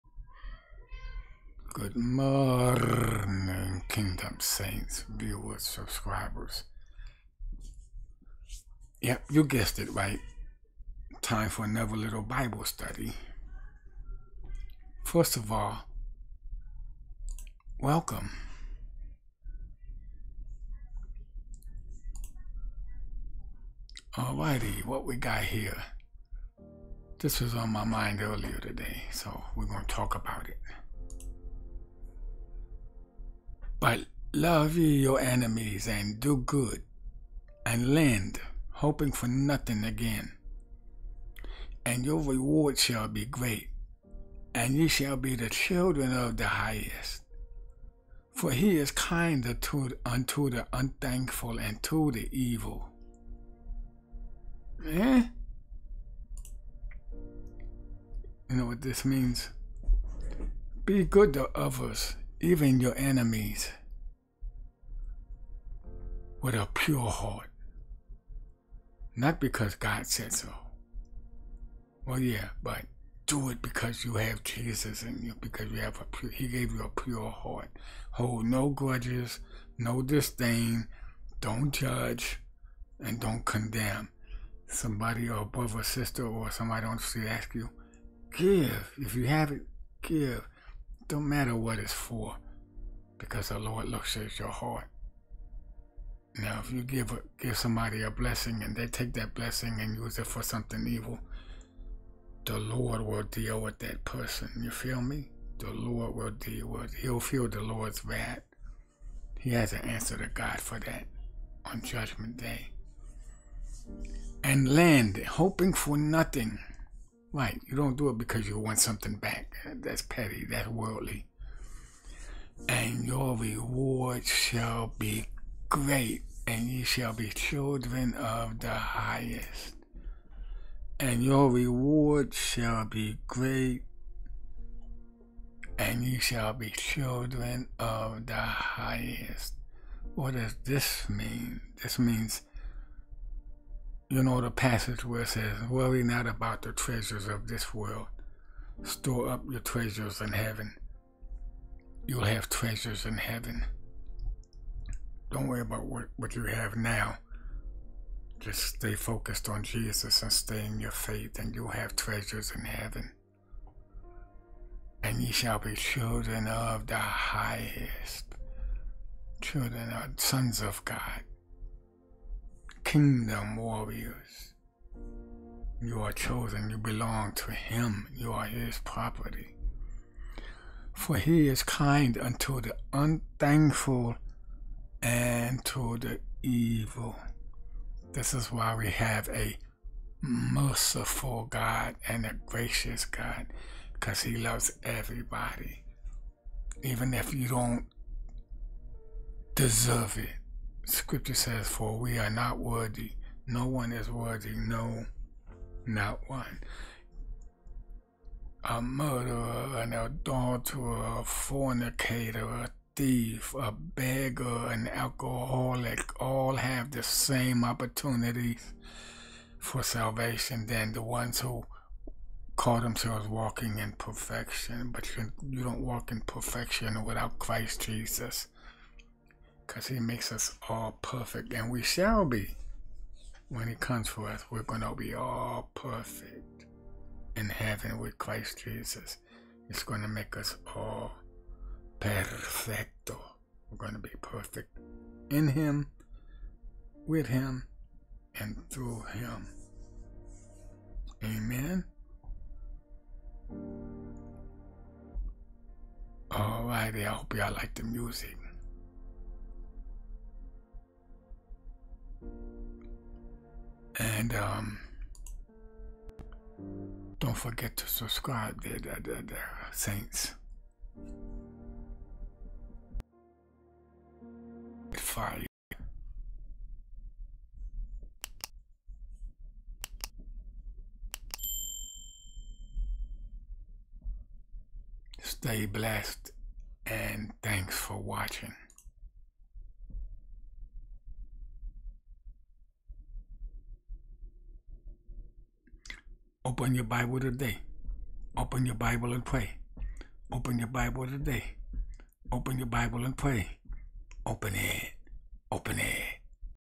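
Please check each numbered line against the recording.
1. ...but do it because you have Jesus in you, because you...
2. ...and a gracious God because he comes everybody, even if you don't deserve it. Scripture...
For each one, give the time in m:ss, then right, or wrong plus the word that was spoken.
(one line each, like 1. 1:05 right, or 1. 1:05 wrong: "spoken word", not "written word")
1. 1:12 right
2. 3:12 wrong: "loves", not "comes".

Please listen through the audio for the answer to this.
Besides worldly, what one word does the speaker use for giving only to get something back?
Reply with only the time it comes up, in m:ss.
2:00.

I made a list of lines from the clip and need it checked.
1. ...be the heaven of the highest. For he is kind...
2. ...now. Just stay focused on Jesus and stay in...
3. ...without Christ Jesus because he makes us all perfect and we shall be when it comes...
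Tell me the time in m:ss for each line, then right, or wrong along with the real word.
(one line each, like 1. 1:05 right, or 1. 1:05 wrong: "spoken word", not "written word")
1. 0:45 wrong: "children", not "heaven"
2. 2:36 right
3. 3:47 right.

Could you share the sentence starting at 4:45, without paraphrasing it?
Stay blessed and thanks for watching.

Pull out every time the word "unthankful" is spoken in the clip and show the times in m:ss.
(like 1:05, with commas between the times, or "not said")
0:50, 3:02.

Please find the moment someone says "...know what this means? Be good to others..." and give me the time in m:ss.
0:58.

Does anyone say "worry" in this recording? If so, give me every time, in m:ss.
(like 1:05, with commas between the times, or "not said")
2:25, 2:35.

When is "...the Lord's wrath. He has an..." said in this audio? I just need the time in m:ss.
1:47.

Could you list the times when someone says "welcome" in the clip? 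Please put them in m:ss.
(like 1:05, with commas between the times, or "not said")
0:17.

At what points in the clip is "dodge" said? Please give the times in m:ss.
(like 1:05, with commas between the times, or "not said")
not said.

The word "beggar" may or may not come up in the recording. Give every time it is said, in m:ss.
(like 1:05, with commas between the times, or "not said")
3:33.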